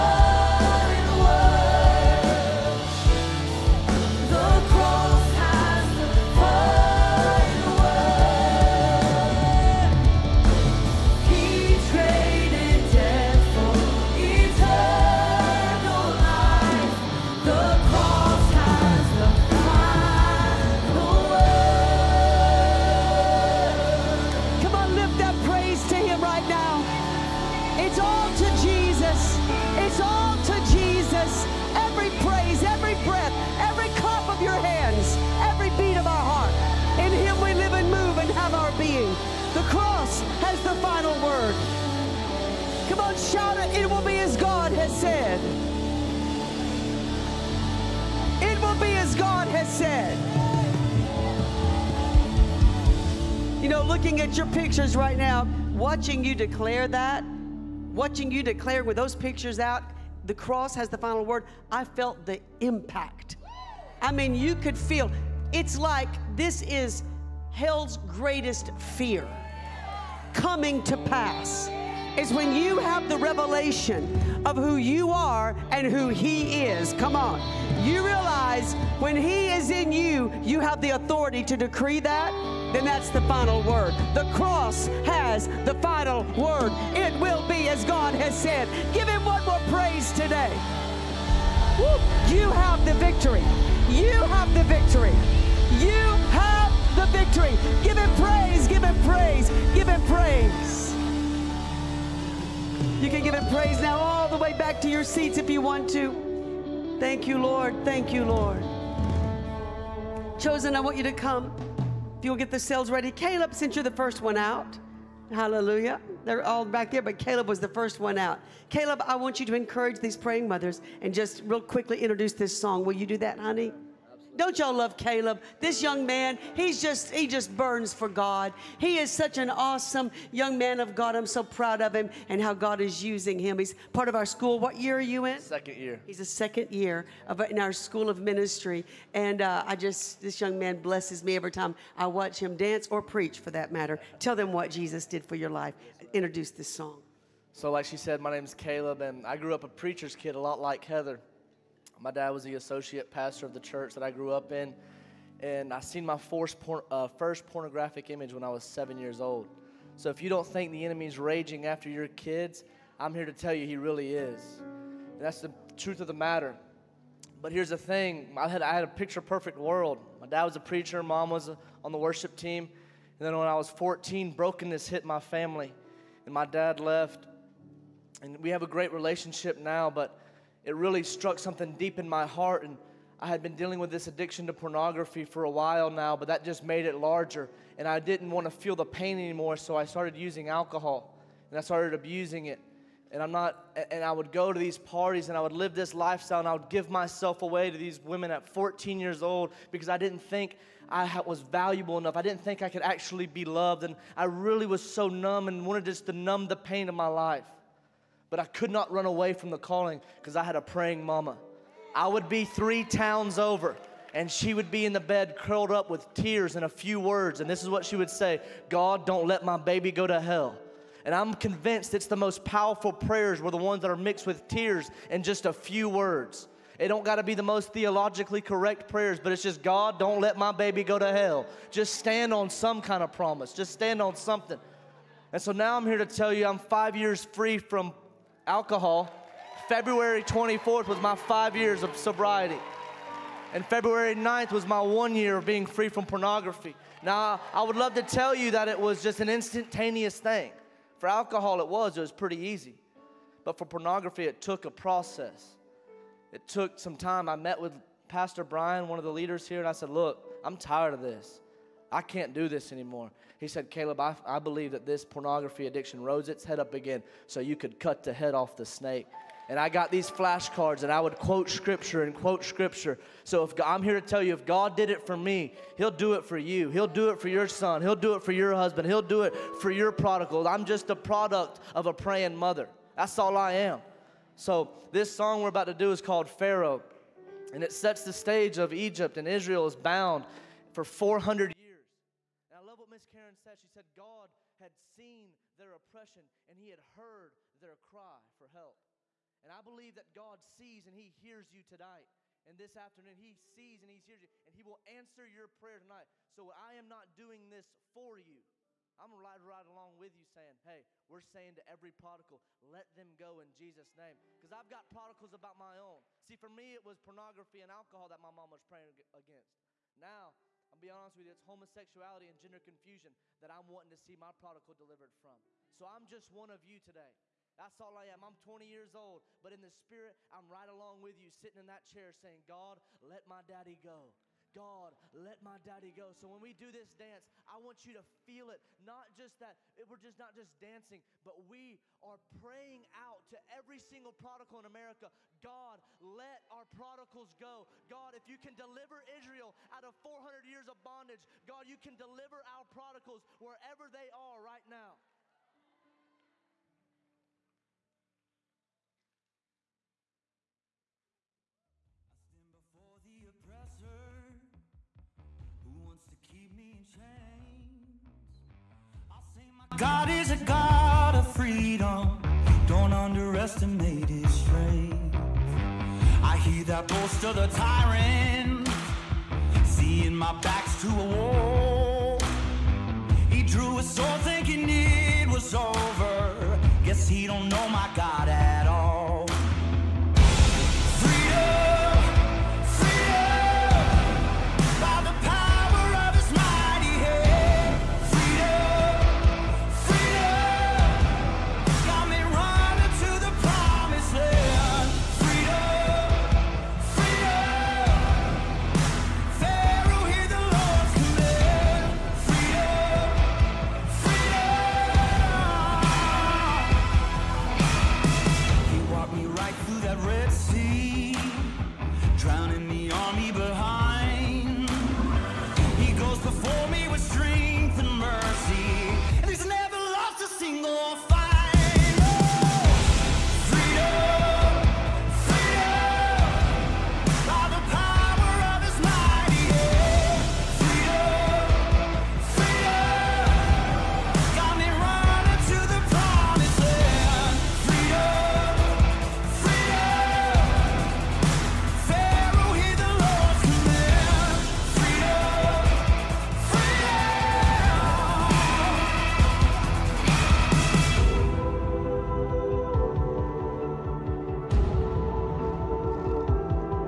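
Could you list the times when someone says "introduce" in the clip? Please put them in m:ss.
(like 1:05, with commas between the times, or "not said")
2:01, 2:26.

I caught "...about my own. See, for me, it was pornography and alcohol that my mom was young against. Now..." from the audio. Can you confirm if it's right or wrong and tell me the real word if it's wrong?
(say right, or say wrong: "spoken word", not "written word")
wrong: "praying", not "young".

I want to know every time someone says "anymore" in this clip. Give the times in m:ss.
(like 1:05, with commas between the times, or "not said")
3:09, 4:22.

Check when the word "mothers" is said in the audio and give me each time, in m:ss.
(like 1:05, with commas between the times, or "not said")
2:00, 4:42.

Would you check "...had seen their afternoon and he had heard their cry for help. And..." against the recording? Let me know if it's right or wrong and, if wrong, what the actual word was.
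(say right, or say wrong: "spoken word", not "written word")
wrong: "oppression", not "afternoon".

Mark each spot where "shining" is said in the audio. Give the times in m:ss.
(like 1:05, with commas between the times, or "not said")
not said.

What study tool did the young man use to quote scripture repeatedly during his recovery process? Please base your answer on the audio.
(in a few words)
flashcards.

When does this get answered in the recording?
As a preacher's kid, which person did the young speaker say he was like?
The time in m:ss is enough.
2:30.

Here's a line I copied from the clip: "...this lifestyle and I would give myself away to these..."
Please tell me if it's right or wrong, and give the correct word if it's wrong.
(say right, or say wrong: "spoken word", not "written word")
right.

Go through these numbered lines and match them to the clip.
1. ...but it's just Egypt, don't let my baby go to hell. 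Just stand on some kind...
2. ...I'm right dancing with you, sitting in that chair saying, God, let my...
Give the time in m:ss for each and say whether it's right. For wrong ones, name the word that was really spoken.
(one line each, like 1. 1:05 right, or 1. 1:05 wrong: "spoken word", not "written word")
1. 3:49 wrong: "God", not "Egypt"
2. 5:30 wrong: "along", not "dancing".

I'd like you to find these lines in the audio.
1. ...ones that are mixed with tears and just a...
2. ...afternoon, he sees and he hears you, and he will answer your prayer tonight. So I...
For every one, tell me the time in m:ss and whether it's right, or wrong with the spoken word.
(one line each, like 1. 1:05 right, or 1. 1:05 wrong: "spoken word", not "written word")
1. 3:43 right
2. 5:02 right.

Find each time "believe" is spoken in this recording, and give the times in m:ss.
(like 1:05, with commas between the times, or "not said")
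4:24, 4:59.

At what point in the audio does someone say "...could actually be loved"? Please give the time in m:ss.
3:22.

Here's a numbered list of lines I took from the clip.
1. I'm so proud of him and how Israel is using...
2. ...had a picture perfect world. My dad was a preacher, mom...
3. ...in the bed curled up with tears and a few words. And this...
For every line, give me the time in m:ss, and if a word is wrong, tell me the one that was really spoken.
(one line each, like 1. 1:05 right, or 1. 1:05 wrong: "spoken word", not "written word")
1. 2:11 wrong: "God", not "Israel"
2. 2:48 right
3. 3:34 right.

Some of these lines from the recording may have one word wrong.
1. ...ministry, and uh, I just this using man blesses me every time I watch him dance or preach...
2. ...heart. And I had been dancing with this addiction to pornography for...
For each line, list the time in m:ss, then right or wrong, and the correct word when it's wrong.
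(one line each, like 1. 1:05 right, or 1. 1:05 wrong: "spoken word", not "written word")
1. 2:18 wrong: "young", not "using"
2. 3:02 wrong: "dealing", not "dancing".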